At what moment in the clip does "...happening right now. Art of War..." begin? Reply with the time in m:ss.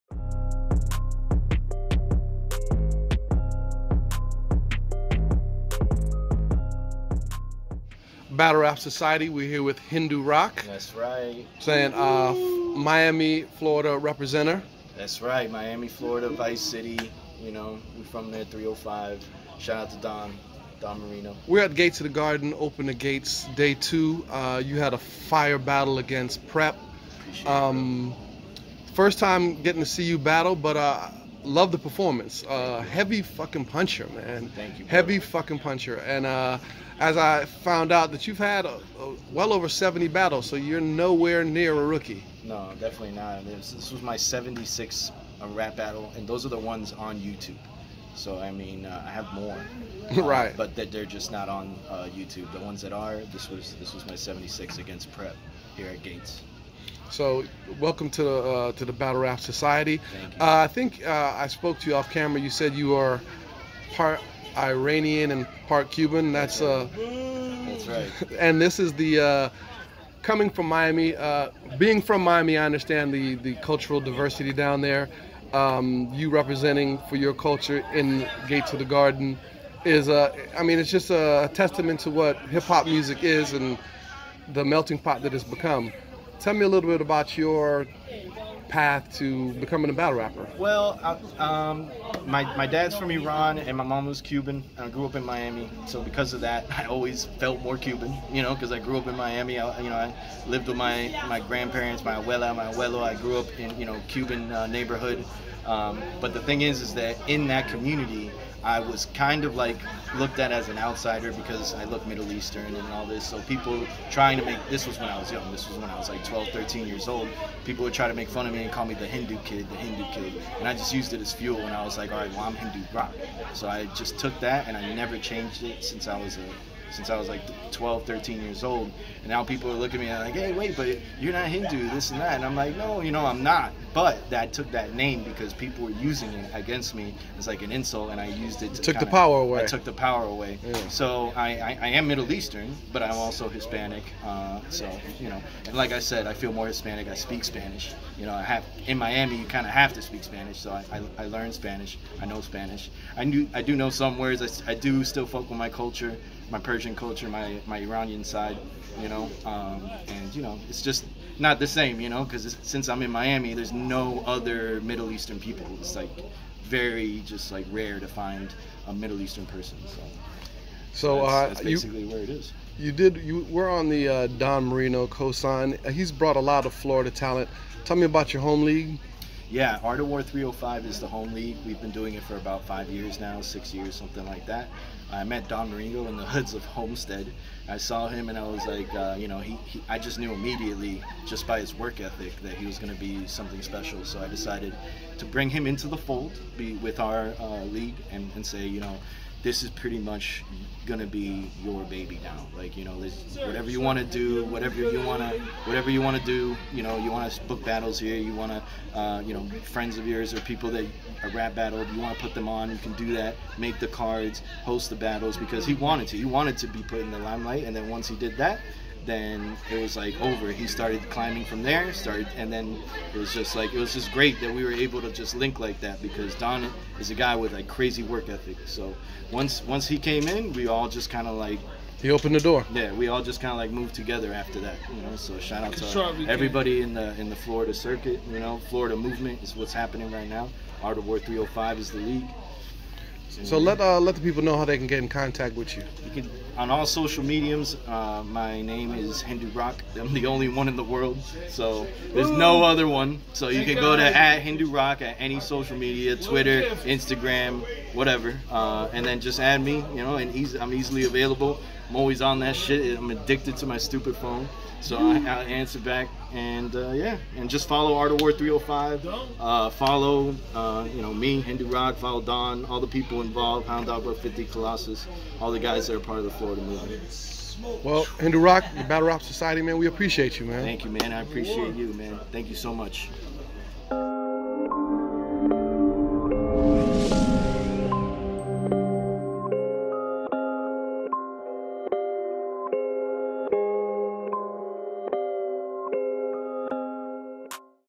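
3:59.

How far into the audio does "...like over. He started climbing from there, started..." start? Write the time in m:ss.
3:39.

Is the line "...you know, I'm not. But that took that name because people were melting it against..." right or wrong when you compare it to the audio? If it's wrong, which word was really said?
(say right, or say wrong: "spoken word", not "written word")
wrong: "using", not "melting".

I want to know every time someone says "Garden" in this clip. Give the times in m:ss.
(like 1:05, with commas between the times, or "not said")
0:22, 1:18.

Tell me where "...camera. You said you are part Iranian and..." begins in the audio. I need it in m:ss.
1:02.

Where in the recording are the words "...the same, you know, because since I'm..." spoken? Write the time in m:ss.
2:41.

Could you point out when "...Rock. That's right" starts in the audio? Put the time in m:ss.
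0:10.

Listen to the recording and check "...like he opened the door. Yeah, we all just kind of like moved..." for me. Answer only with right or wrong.
right.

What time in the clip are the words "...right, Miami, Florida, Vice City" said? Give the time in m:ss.
0:15.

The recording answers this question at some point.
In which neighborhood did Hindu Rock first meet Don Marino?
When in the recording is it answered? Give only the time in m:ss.
3:06.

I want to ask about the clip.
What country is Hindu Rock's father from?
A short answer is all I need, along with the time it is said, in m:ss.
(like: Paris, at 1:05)
Iran, at 1:33.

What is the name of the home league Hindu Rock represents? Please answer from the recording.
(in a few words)
Art of War 305.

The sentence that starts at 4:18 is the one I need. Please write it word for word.
Uh, and then just add me, you know, and easy, I'm easily available.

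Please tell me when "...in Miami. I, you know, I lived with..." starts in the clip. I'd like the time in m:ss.
1:39.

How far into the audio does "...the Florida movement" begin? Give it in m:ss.
4:36.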